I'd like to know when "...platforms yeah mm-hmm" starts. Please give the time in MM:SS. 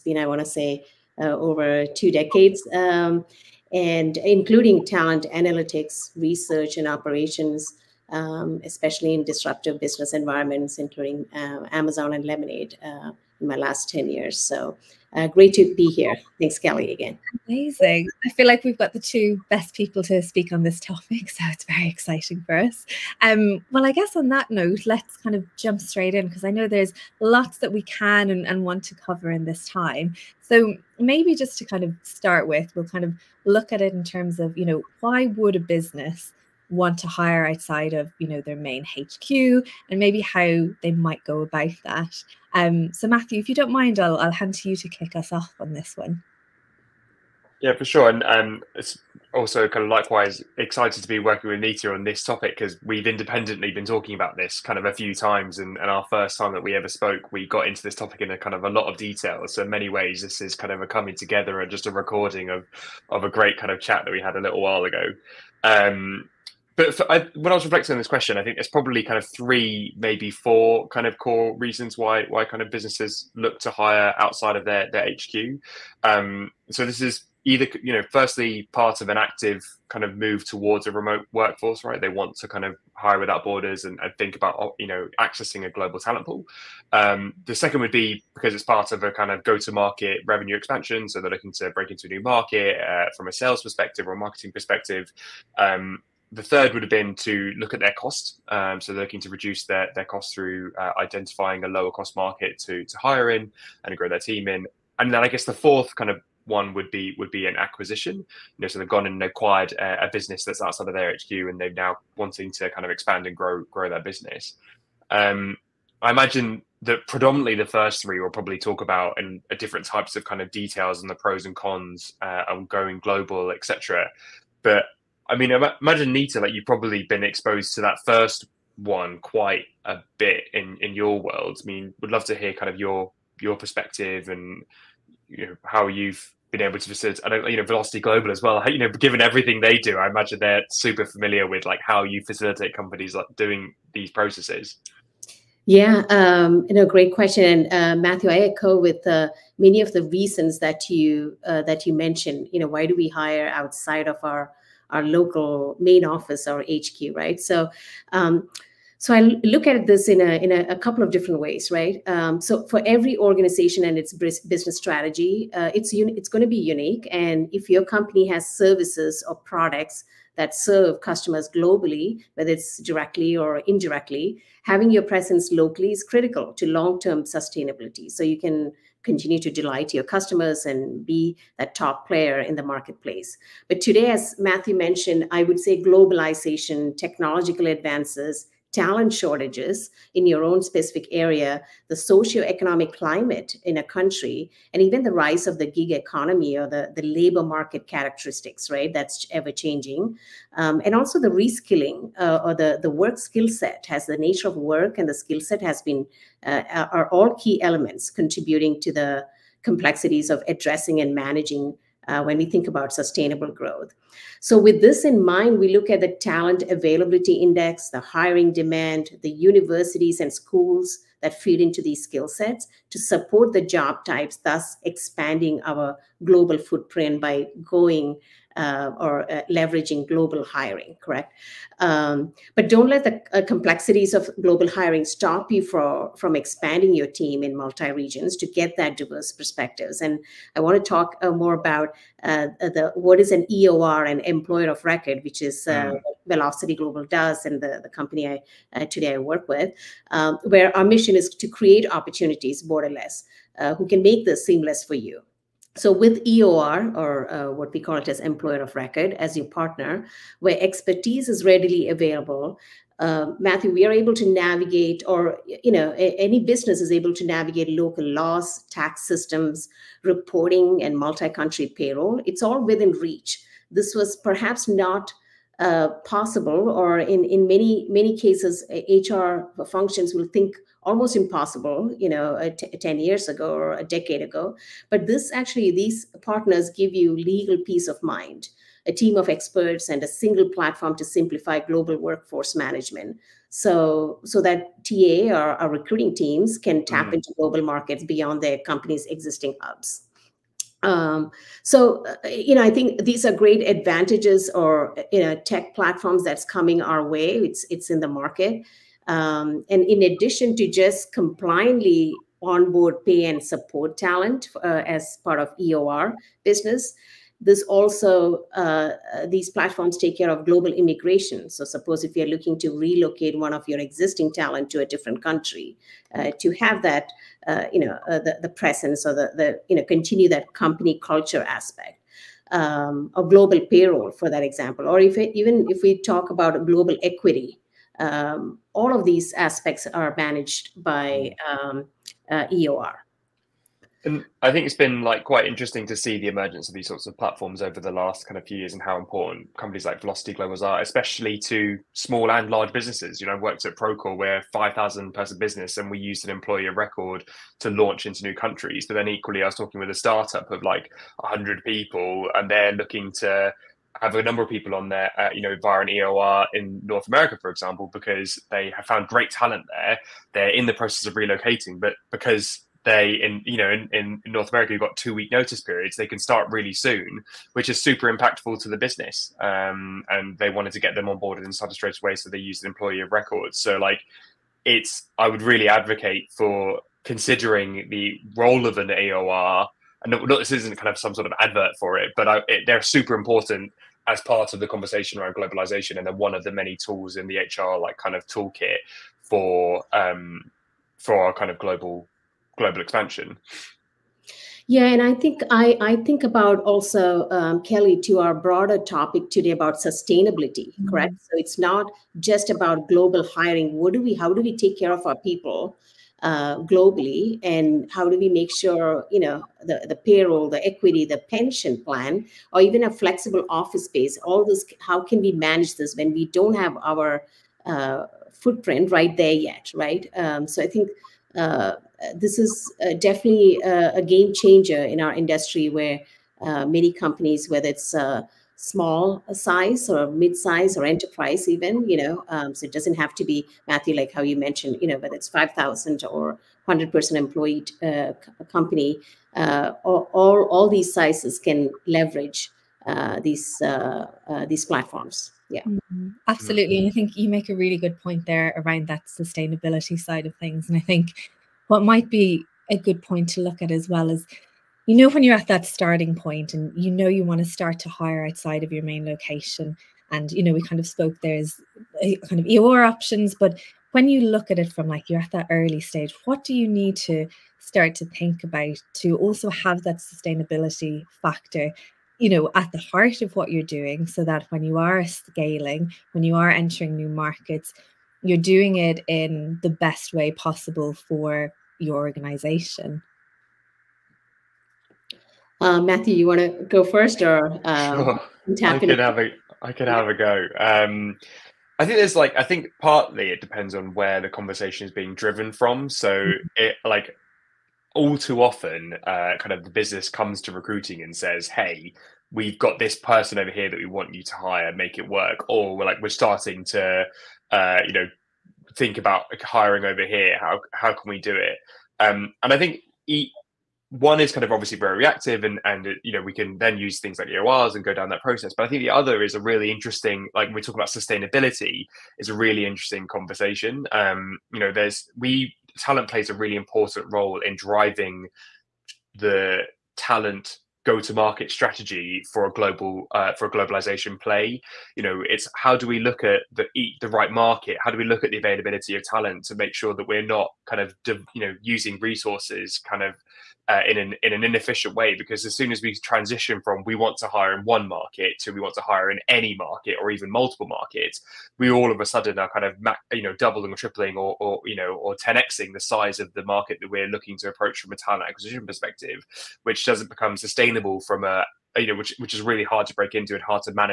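07:34.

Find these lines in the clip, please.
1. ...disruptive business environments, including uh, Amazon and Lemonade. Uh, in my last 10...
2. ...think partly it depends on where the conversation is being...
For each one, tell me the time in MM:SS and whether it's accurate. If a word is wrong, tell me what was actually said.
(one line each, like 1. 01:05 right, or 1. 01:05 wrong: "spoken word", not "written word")
1. 00:09 right
2. 08:22 right.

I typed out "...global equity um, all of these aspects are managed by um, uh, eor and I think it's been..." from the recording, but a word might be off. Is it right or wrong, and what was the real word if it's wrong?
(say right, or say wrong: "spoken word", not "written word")
right.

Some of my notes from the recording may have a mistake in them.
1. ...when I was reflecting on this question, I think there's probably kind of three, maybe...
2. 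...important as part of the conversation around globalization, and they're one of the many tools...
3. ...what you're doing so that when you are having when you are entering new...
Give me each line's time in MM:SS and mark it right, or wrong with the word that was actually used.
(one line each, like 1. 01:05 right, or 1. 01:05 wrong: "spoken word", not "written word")
1. 01:07 right
2. 06:33 right
3. 08:03 wrong: "scaling", not "having".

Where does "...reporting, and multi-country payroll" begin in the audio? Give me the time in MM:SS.
04:30.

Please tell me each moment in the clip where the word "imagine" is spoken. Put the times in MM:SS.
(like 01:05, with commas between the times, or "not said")
01:56, 02:05, 02:20.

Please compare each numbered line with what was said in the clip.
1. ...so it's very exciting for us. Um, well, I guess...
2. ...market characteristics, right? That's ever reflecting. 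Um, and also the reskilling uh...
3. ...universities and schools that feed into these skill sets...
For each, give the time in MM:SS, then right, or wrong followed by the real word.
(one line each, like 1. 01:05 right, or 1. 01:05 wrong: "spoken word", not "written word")
1. 00:21 right
2. 03:17 wrong: "changing", not "reflecting"
3. 03:39 right.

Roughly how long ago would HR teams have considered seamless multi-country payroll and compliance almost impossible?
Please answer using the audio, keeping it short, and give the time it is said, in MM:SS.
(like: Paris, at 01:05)
A decade ago, at 04:43.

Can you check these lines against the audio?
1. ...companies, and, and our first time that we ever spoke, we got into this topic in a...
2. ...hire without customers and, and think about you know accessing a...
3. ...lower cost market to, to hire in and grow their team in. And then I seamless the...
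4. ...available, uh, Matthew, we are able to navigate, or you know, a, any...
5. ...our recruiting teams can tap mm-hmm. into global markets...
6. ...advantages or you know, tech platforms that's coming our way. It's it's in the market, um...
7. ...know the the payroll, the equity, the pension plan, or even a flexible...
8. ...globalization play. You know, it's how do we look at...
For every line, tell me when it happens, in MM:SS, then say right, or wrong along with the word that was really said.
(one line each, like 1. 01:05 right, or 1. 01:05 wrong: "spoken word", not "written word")
1. 00:55 wrong: "times", not "companies"
2. 01:22 wrong: "borders", not "customers"
3. 01:41 wrong: "guess", not "seamless"
4. 04:21 right
5. 04:55 right
6. 05:03 right
7. 06:59 right
8. 09:03 right.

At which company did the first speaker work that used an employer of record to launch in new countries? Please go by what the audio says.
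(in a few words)
Procore.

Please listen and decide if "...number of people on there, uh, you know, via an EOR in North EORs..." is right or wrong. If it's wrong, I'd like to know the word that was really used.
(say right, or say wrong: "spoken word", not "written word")
wrong: "America", not "EORs".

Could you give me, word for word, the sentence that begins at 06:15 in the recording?
They can start really soon, which is super impactful to the business.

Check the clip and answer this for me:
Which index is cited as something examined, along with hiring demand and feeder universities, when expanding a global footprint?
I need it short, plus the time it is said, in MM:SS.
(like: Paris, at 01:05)
Talent availability index, at 03:36.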